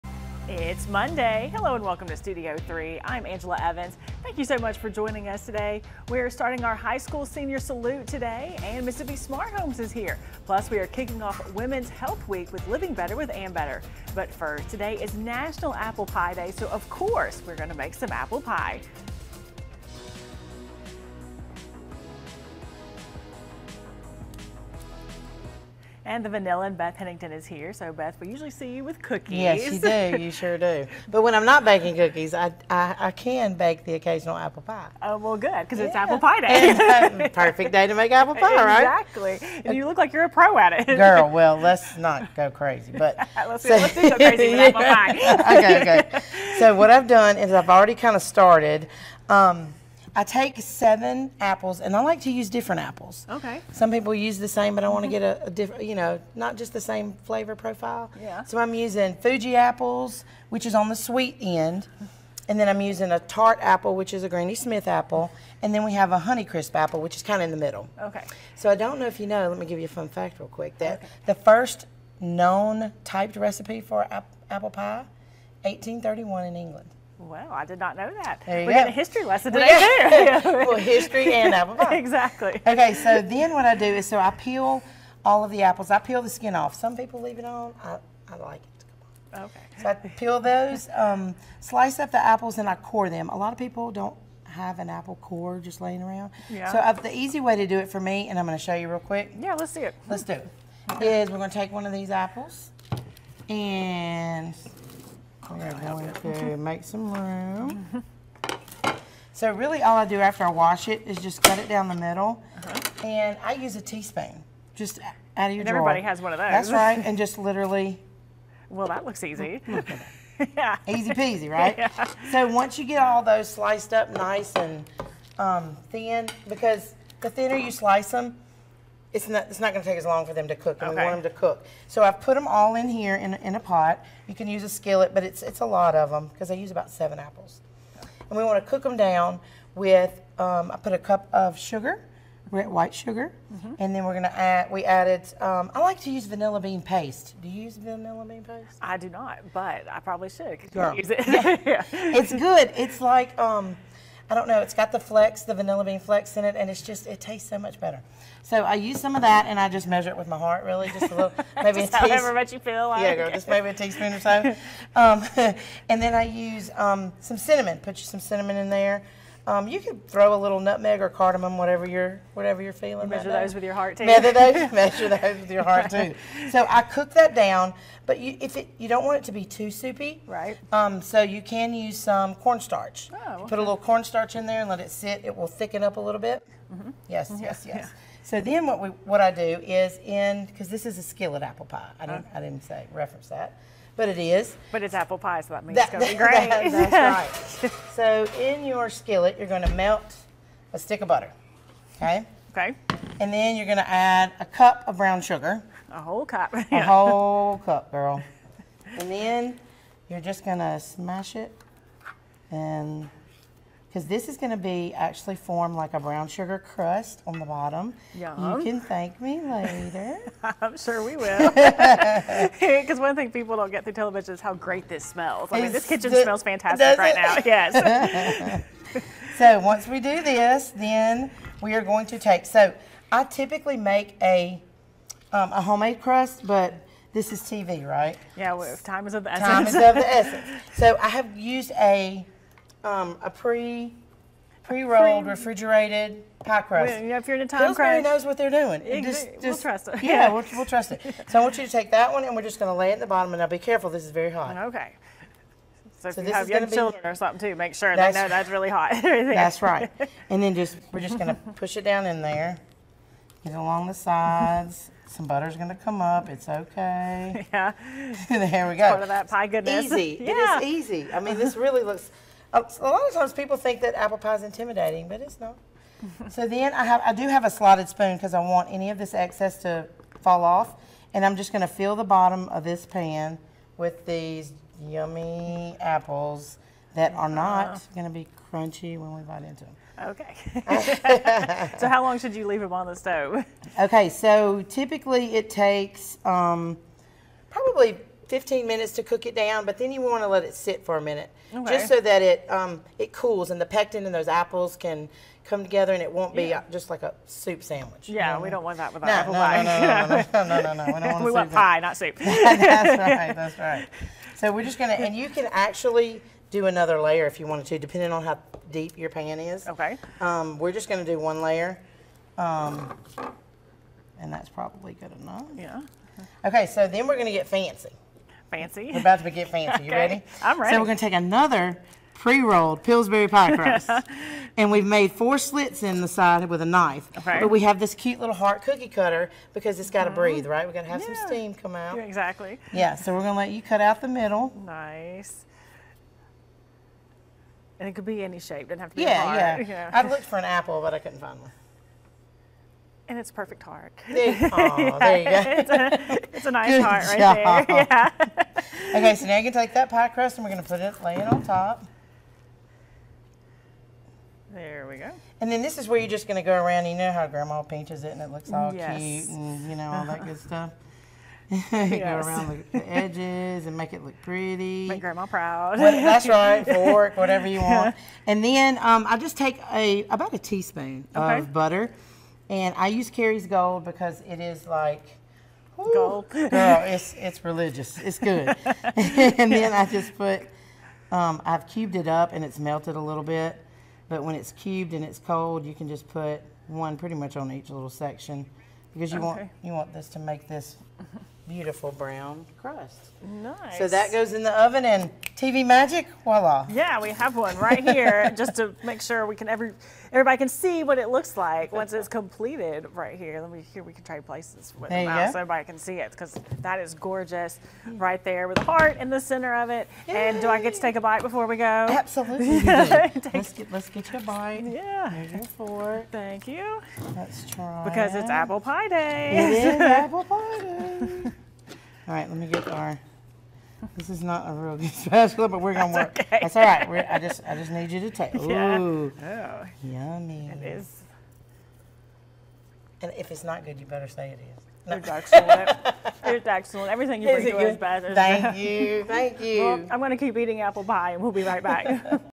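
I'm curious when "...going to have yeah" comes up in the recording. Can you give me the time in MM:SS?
05:40.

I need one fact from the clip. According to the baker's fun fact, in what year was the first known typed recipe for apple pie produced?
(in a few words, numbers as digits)
1831.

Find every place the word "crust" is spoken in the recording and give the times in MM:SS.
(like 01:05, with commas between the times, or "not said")
03:36, 03:55, 04:06, 05:33, 06:00, 06:42.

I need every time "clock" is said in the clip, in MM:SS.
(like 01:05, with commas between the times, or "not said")
not said.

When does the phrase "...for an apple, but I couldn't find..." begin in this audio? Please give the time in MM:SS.
05:50.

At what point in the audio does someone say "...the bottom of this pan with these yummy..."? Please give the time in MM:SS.
04:41.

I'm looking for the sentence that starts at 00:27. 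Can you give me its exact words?
So Beth, we usually see you with cookies.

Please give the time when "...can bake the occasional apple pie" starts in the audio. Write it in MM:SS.
00:33.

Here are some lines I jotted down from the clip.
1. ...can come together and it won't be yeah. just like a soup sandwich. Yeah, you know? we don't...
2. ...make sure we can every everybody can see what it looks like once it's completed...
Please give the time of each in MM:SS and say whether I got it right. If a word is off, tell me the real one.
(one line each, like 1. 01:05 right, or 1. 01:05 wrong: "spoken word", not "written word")
1. 05:04 right
2. 06:48 right.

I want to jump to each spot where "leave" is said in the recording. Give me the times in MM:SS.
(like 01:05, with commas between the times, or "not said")
01:27, 04:52.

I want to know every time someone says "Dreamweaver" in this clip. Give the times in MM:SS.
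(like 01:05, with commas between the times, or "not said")
not said.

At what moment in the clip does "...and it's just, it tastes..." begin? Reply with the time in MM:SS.
02:36.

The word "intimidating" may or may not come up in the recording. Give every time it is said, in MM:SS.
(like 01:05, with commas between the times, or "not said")
04:34.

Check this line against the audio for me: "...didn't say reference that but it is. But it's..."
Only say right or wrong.
right.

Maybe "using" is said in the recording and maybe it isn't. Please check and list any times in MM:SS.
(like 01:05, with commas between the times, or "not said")
00:58, 01:02.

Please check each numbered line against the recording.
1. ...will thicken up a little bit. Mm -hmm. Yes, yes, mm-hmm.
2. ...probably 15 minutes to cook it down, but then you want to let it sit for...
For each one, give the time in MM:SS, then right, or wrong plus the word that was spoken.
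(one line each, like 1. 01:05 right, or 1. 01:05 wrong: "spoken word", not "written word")
1. 03:05 right
2. 04:57 right.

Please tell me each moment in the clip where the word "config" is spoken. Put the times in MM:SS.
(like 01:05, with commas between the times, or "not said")
not said.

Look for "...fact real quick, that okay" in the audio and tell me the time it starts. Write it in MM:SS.
01:10.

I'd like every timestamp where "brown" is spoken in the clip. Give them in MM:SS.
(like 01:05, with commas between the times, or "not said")
03:24, 03:35, 06:41.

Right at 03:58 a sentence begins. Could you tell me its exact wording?
Yeah, well, time is of the essence.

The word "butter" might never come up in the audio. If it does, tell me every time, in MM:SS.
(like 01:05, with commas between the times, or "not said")
03:21, 04:25, 06:21.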